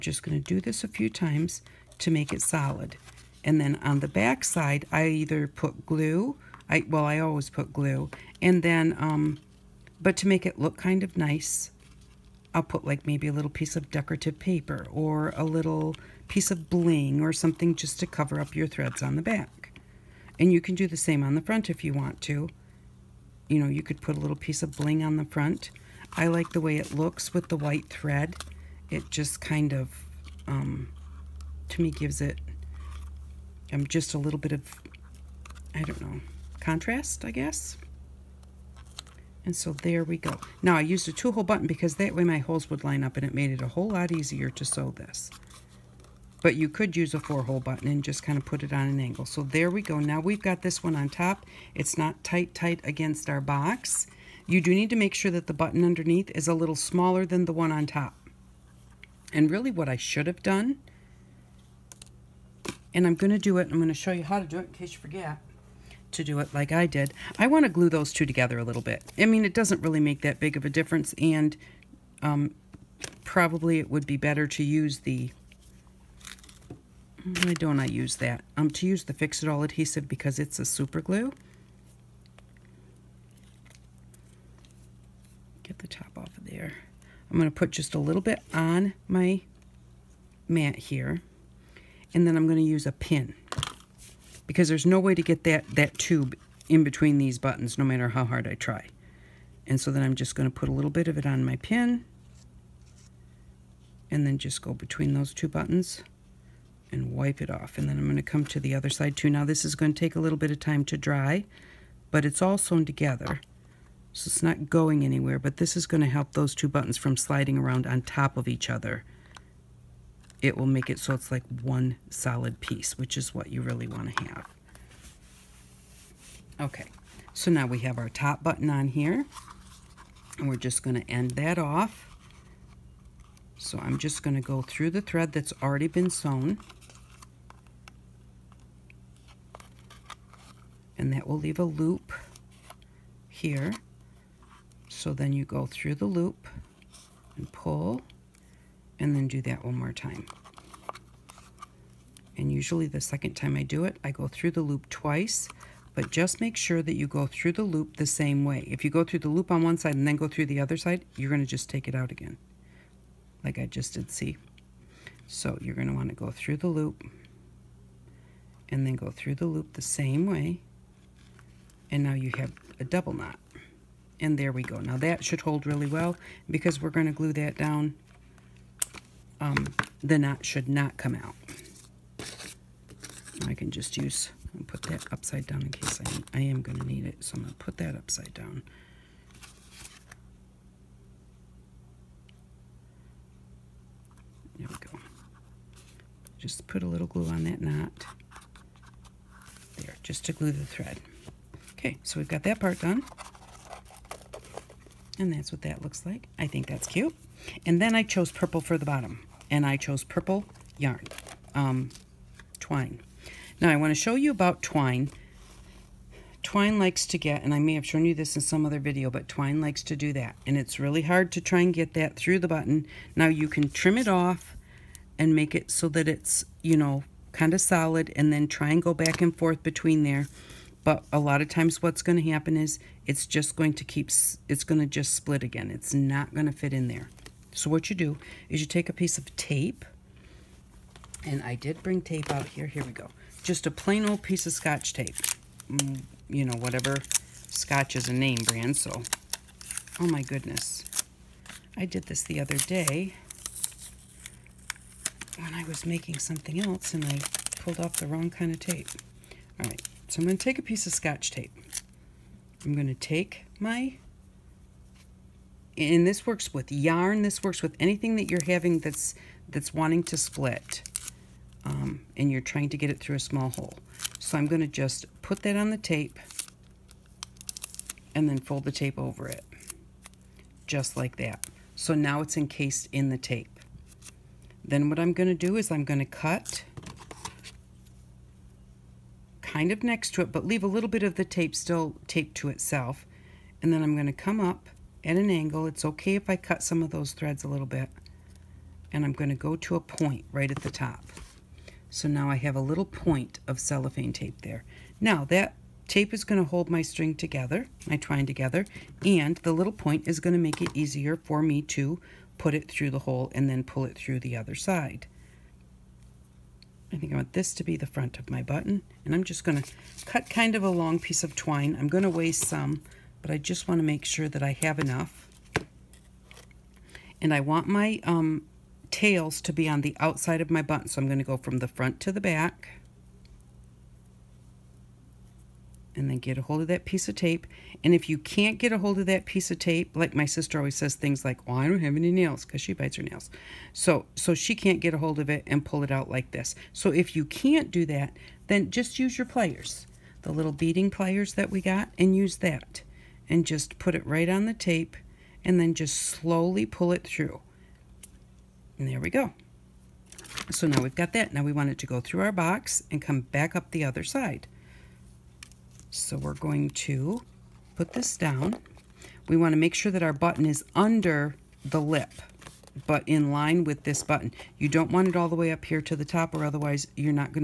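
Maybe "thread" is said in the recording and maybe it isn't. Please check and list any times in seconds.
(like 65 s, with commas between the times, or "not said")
18 s, 27 s, 135 s, 200 s, 297 s.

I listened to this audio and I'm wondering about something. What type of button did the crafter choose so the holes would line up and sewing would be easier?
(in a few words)
Two-hole button.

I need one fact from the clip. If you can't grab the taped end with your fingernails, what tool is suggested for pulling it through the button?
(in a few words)
Beading pliers.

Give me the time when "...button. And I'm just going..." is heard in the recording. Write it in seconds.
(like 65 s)
318 s.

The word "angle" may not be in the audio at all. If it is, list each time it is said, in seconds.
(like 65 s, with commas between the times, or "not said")
49 s, 295 s.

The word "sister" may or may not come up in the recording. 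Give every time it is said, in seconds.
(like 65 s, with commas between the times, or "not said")
340 s.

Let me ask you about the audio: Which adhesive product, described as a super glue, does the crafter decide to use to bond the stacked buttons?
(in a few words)
Fix It All.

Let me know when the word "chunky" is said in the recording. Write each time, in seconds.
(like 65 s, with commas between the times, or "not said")
not said.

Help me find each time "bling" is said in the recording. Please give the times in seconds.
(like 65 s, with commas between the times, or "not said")
16 s, 24 s.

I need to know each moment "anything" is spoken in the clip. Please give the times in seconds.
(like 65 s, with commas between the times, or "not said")
267 s.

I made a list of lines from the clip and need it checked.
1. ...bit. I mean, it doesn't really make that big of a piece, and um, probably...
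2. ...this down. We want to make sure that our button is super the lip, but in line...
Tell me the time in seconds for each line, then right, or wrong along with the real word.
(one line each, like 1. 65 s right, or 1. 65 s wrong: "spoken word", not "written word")
1. 68 s wrong: "difference", not "piece"
2. 367 s wrong: "under", not "super".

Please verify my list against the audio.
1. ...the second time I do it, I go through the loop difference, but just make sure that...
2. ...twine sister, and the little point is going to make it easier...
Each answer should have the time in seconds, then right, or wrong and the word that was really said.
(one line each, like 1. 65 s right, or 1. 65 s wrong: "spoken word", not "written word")
1. 152 s wrong: "twice", not "difference"
2. 307 s wrong: "together", not "sister".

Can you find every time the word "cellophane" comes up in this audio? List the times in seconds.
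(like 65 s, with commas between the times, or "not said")
303 s.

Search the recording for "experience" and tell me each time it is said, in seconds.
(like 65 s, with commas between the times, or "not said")
not said.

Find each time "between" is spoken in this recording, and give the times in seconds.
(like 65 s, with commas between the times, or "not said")
96 s, 104 s, 229 s.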